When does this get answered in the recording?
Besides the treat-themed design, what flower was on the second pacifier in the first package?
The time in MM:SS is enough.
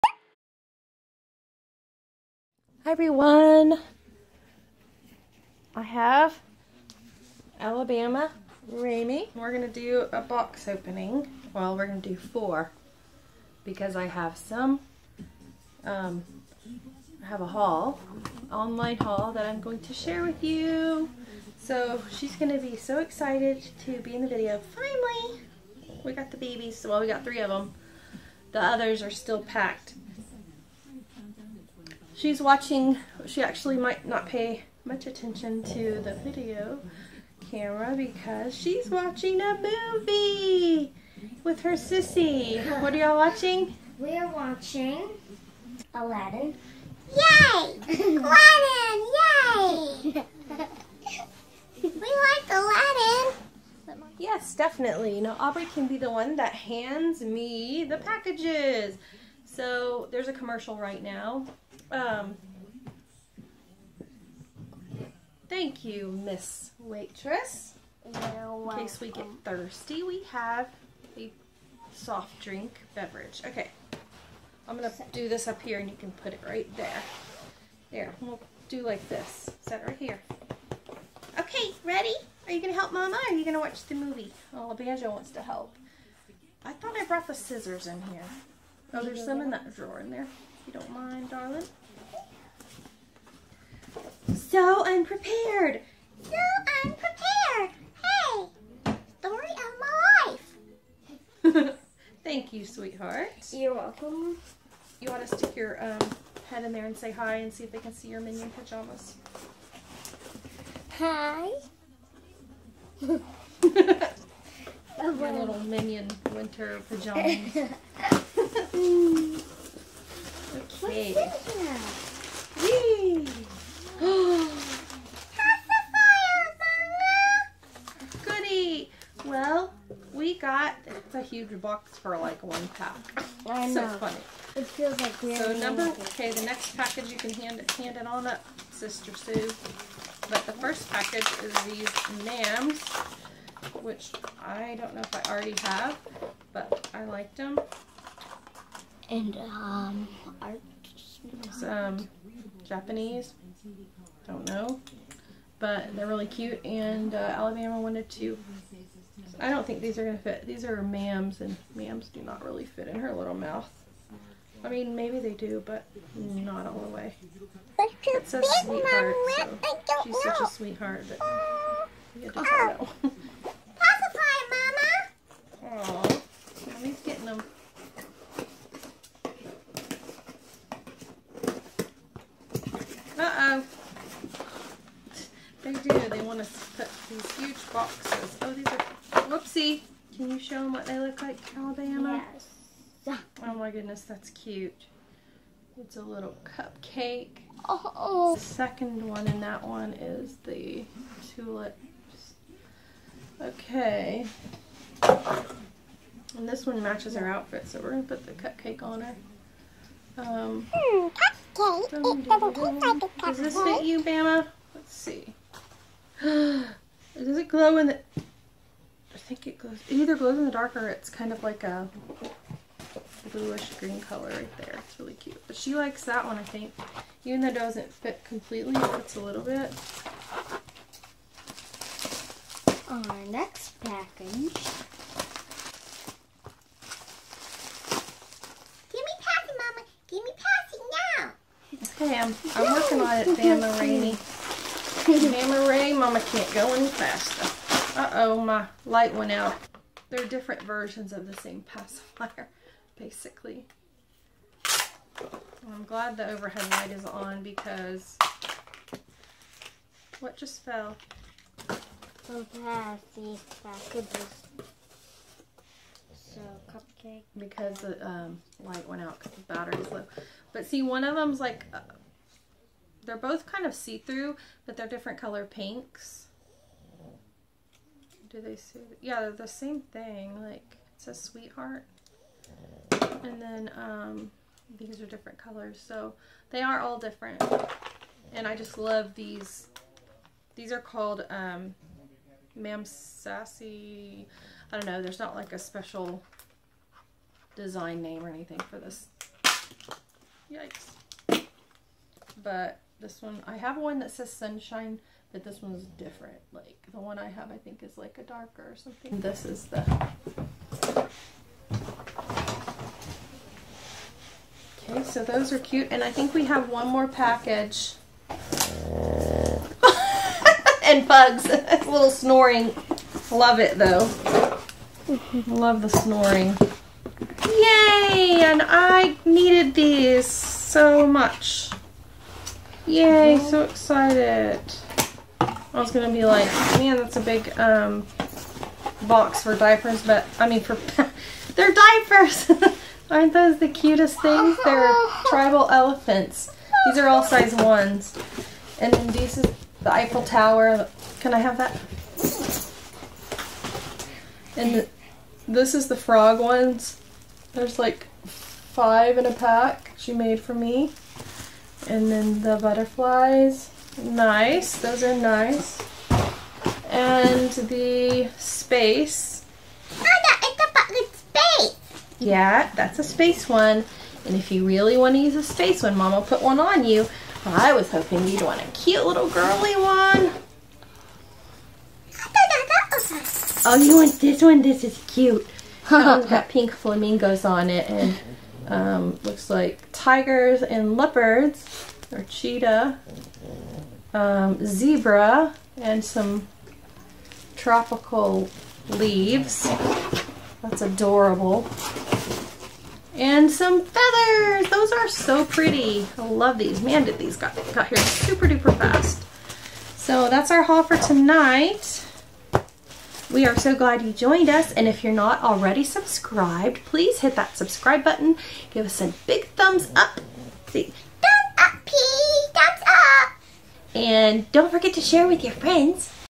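03:21.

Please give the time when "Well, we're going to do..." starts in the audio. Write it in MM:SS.
00:11.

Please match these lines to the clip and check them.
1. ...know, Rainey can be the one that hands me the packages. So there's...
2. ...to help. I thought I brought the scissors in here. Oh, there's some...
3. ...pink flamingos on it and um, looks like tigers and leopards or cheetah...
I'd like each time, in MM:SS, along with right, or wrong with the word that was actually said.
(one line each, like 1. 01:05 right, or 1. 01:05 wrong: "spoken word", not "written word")
1. 00:55 wrong: "Aubrey", not "Rainey"
2. 01:25 right
3. 06:26 right.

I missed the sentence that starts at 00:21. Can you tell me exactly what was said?
So she's going to be so excited to be in the video.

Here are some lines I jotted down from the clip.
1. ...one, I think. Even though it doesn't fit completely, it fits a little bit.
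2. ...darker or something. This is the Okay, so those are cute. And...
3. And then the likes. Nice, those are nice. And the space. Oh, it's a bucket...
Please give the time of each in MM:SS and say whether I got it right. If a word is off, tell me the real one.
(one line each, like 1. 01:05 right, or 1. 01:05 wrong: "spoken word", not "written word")
1. 03:46 right
2. 05:08 right
3. 06:01 wrong: "butterflies", not "likes".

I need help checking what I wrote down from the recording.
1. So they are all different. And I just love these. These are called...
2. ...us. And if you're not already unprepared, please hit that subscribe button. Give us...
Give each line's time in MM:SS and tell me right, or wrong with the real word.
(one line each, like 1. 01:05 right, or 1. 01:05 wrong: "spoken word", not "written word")
1. 04:45 right
2. 06:54 wrong: "subscribed", not "unprepared".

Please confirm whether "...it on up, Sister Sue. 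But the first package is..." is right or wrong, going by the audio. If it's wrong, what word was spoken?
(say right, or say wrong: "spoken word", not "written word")
right.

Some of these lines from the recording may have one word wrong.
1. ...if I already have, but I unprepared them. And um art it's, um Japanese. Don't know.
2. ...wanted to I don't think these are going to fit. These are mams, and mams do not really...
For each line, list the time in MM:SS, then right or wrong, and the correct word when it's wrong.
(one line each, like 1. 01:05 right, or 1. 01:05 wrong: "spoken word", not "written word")
1. 02:25 wrong: "liked", not "unprepared"
2. 02:37 right.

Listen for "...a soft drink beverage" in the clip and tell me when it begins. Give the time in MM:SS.
01:11.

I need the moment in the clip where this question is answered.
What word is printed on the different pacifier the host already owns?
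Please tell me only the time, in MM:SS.
05:04.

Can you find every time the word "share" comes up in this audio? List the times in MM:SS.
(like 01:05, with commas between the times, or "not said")
00:19, 07:05.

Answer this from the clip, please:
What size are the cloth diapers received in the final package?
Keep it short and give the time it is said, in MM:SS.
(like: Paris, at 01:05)
Size 1, at 05:47.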